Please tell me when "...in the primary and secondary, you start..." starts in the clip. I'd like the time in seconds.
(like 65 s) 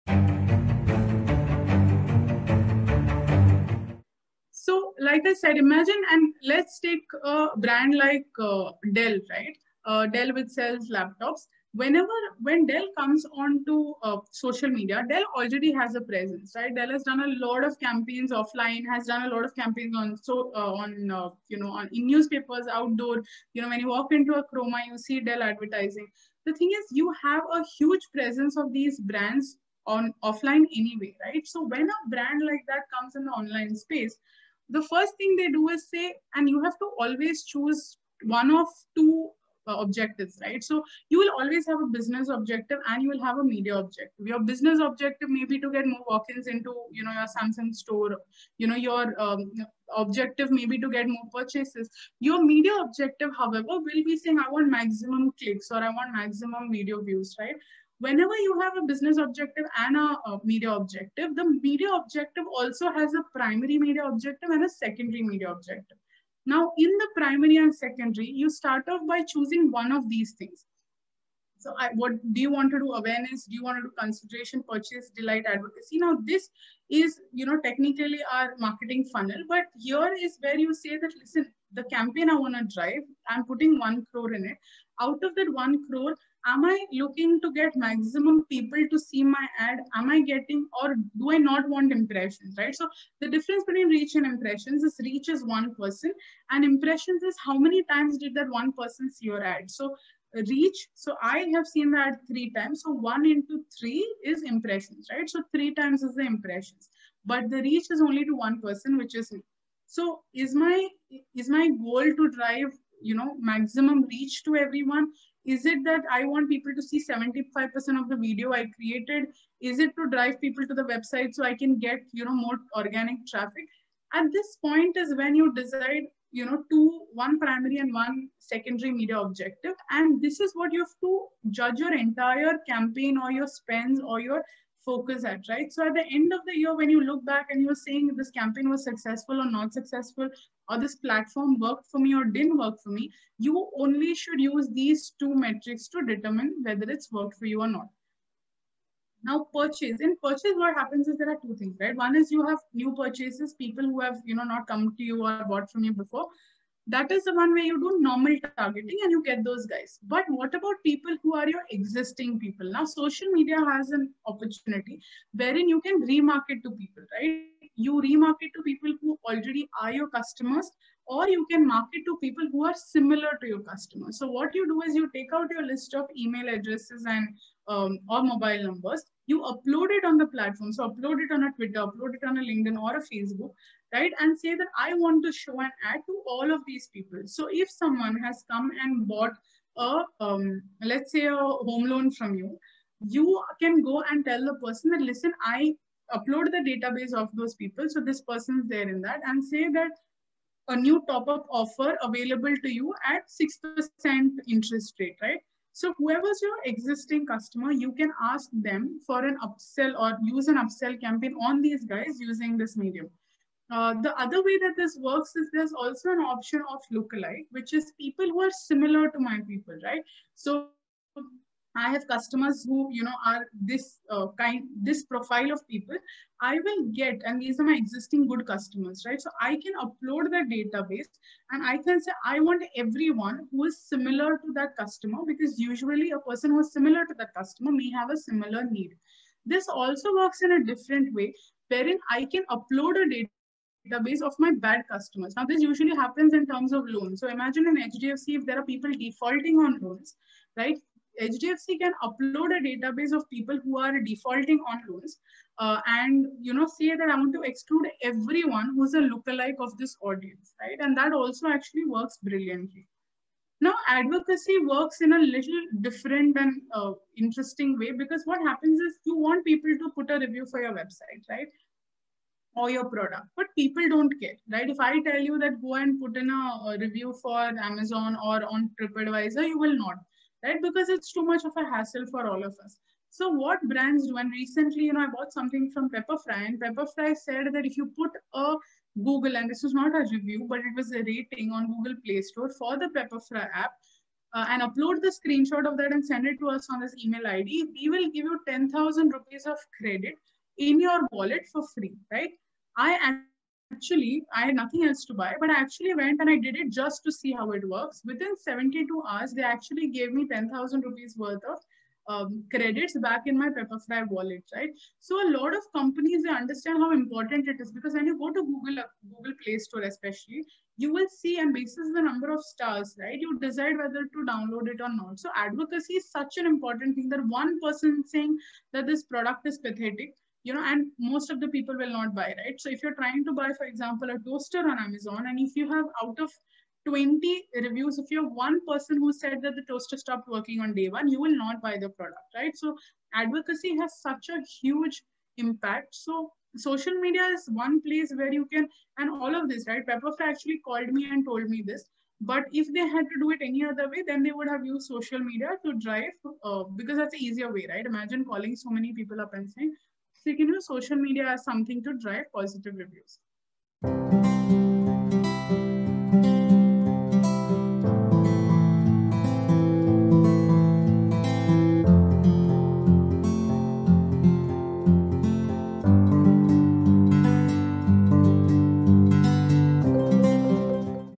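66 s.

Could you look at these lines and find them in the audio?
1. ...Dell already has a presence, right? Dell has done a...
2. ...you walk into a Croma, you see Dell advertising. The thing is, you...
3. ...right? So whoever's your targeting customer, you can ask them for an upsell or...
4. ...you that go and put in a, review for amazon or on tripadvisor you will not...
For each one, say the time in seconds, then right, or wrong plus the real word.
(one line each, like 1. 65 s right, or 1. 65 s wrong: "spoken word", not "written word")
1. 15 s right
2. 23 s right
3. 205 s wrong: "existing", not "targeting"
4. 275 s right.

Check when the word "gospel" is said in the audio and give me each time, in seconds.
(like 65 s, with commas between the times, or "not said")
not said.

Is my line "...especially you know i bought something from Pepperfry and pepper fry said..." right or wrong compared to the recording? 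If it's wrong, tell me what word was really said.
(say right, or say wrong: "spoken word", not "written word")
wrong: "recently", not "especially".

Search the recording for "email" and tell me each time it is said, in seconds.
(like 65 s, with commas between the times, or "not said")
176 s, 297 s.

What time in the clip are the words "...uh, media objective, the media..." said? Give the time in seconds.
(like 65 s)
60 s.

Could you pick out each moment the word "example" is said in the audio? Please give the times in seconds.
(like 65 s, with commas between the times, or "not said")
333 s.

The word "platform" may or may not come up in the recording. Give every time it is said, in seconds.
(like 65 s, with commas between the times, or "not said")
140 s, 180 s.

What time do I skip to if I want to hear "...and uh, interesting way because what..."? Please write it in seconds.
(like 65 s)
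266 s.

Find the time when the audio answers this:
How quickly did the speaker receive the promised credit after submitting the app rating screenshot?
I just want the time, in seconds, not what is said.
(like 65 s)
308 s.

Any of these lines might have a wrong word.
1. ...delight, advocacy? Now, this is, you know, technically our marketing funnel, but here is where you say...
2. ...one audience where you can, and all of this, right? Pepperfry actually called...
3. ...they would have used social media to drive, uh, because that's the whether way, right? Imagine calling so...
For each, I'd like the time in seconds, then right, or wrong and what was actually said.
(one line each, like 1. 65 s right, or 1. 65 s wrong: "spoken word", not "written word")
1. 75 s right
2. 347 s wrong: "place", not "audience"
3. 354 s wrong: "easier", not "whether".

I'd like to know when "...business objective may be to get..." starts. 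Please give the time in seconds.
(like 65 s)
44 s.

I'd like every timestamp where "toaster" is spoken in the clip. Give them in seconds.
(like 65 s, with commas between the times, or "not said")
334 s, 339 s.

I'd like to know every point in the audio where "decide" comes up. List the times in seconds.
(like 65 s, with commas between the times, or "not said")
125 s, 323 s.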